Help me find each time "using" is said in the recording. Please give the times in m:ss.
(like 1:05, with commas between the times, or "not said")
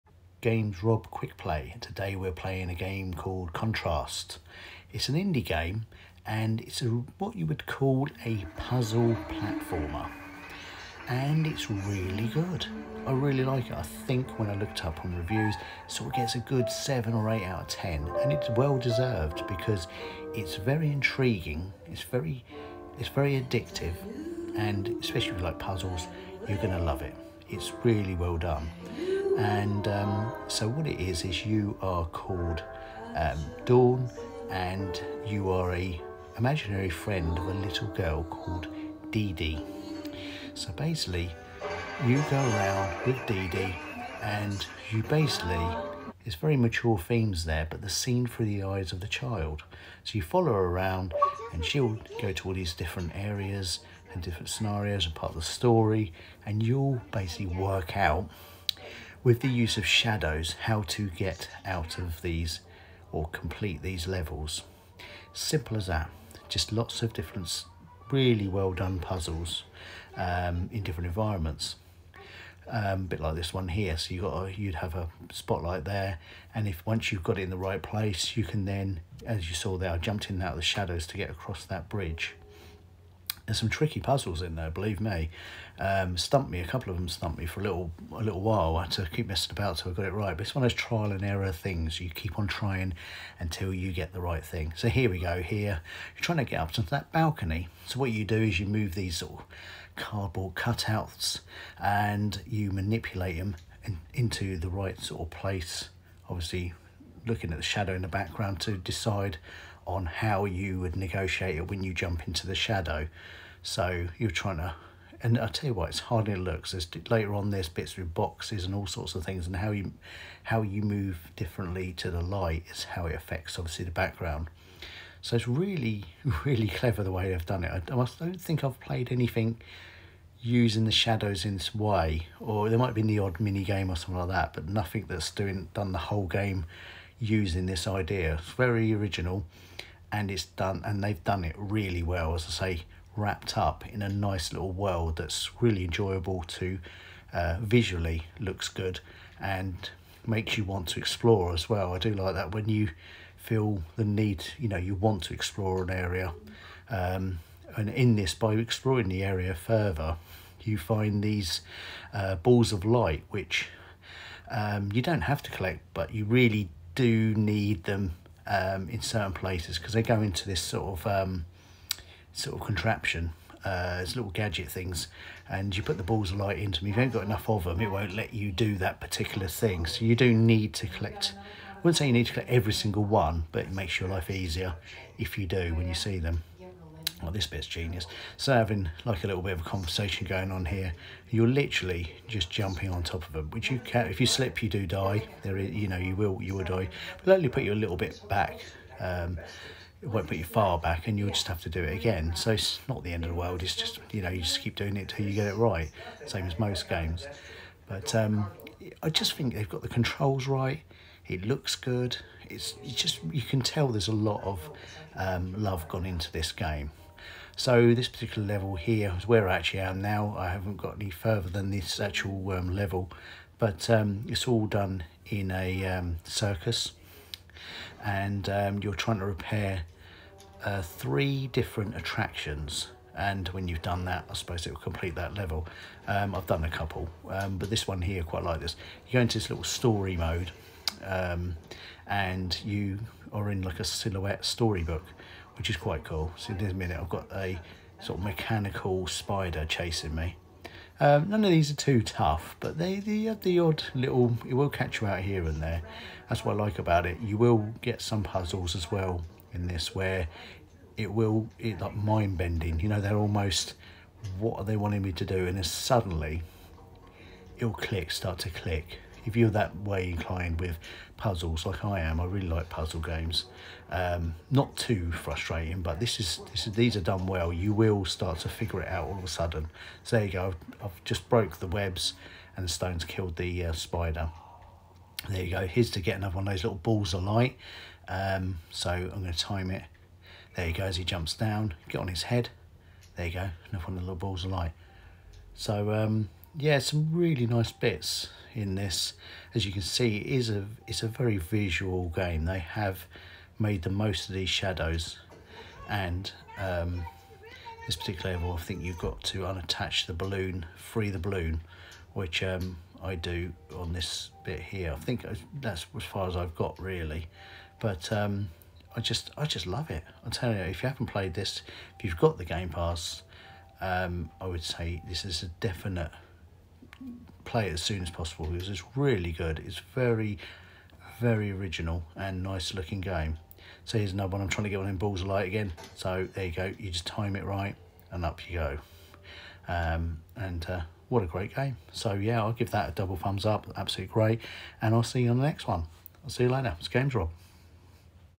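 2:10, 2:17.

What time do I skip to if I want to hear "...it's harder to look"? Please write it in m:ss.
1:55.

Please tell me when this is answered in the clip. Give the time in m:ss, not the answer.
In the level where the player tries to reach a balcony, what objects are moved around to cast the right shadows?
1:39.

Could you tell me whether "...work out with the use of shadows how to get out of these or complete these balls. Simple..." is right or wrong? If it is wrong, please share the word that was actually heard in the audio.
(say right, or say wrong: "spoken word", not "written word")
wrong: "levels", not "balls".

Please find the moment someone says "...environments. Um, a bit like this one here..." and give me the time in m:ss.
1:11.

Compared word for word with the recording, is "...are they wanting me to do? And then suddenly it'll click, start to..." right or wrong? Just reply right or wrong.
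right.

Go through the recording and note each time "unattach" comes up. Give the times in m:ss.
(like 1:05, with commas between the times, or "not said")
5:09.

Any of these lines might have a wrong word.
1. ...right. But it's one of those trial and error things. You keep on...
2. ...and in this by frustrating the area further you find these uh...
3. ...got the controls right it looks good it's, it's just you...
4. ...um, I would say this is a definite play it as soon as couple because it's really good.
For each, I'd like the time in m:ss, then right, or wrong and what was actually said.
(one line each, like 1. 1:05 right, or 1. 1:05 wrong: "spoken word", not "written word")
1. 1:30 right
2. 2:37 wrong: "exploring", not "frustrating"
3. 3:29 right
4. 5:23 wrong: "possible", not "couple".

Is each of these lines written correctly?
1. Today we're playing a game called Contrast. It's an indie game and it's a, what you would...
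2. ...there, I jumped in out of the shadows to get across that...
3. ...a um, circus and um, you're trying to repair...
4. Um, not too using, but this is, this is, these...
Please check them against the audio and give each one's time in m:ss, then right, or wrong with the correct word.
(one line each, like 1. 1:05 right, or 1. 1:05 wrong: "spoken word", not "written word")
1. 0:01 right
2. 1:19 right
3. 3:45 right
4. 4:33 wrong: "frustrating", not "using".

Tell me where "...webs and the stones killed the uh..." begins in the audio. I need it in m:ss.
4:41.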